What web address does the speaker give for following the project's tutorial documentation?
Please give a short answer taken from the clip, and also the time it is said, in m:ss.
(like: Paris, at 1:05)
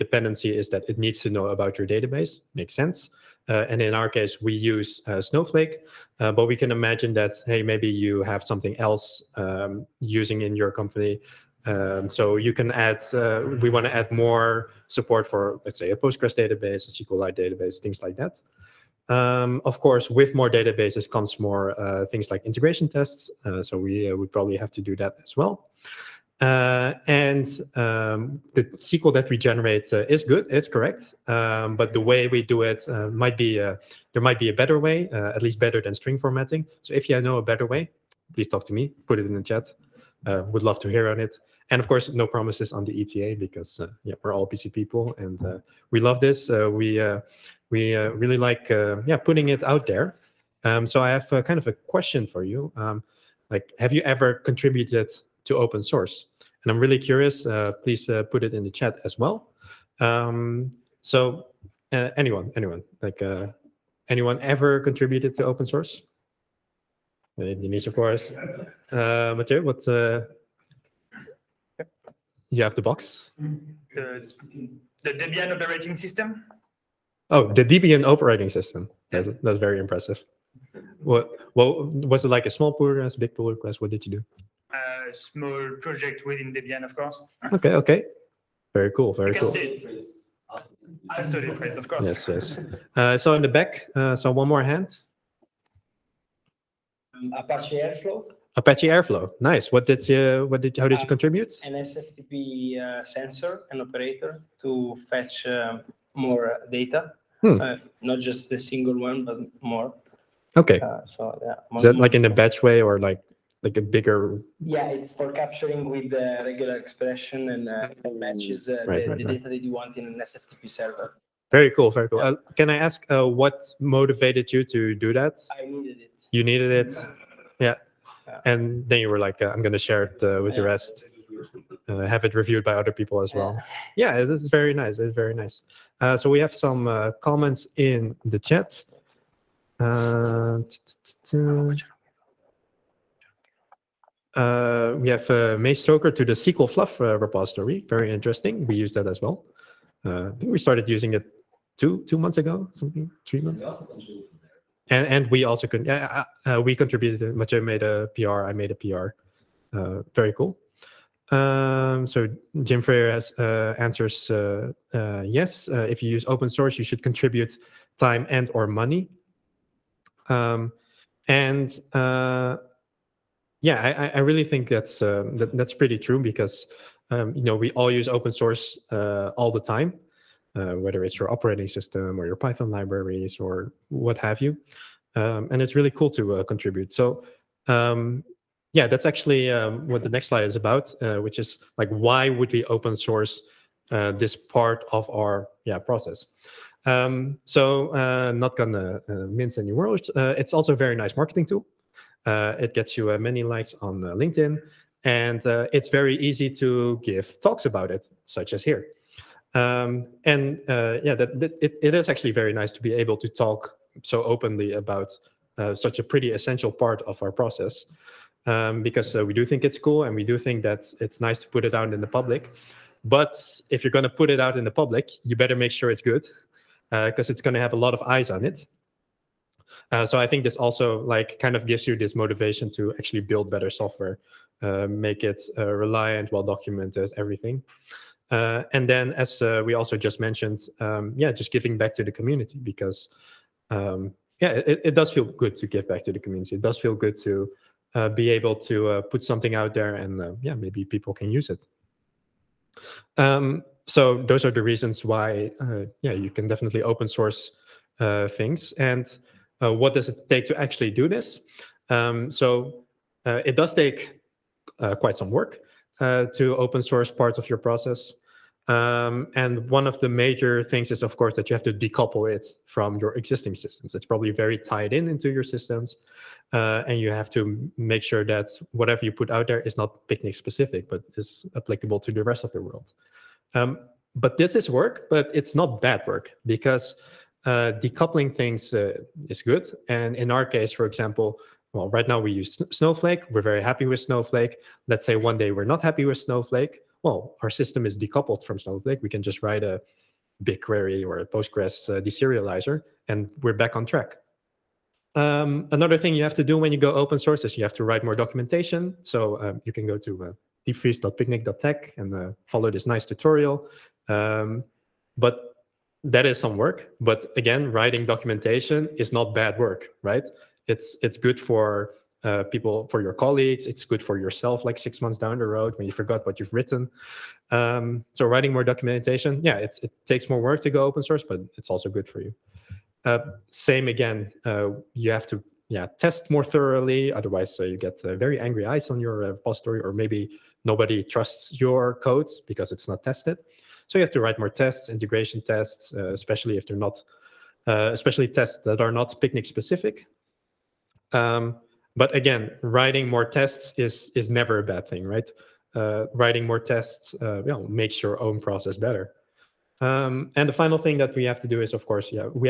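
diepvries.picnic.tech, at 5:10.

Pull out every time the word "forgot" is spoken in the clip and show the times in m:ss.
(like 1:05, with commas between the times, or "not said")
5:25.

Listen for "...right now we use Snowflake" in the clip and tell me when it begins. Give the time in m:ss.
4:51.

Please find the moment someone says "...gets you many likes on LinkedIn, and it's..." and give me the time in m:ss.
3:22.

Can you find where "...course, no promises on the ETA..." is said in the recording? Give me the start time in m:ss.
0:41.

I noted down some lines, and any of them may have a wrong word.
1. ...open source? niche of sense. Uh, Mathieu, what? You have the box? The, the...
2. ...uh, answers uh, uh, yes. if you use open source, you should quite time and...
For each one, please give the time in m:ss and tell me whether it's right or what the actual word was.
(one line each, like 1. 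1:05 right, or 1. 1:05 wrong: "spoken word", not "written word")
1. 1:05 wrong: "course", not "sense"
2. 2:43 wrong: "contribute", not "quite".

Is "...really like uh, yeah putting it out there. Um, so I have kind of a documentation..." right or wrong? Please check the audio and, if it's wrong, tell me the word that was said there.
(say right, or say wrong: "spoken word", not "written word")
wrong: "question", not "documentation".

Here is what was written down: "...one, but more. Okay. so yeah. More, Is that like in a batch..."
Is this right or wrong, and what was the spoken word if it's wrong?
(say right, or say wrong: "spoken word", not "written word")
right.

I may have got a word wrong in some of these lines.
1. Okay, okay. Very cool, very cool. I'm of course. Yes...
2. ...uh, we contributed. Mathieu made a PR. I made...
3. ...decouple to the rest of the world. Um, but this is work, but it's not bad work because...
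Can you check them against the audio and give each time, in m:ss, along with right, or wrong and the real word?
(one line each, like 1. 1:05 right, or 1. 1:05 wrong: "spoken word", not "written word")
1. 1:27 right
2. 2:36 right
3. 4:41 wrong: "applicable", not "decouple".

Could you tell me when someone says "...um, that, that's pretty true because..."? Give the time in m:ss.
2:55.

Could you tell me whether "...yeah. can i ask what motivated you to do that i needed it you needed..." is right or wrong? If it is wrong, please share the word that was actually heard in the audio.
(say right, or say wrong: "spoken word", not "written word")
right.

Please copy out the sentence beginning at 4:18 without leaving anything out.
And what does it take to actually do this?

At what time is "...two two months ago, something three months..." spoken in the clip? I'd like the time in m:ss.
2:31.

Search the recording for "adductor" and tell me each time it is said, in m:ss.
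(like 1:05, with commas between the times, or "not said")
not said.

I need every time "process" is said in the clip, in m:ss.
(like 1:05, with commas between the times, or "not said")
3:15, 3:37, 4:27, 5:58.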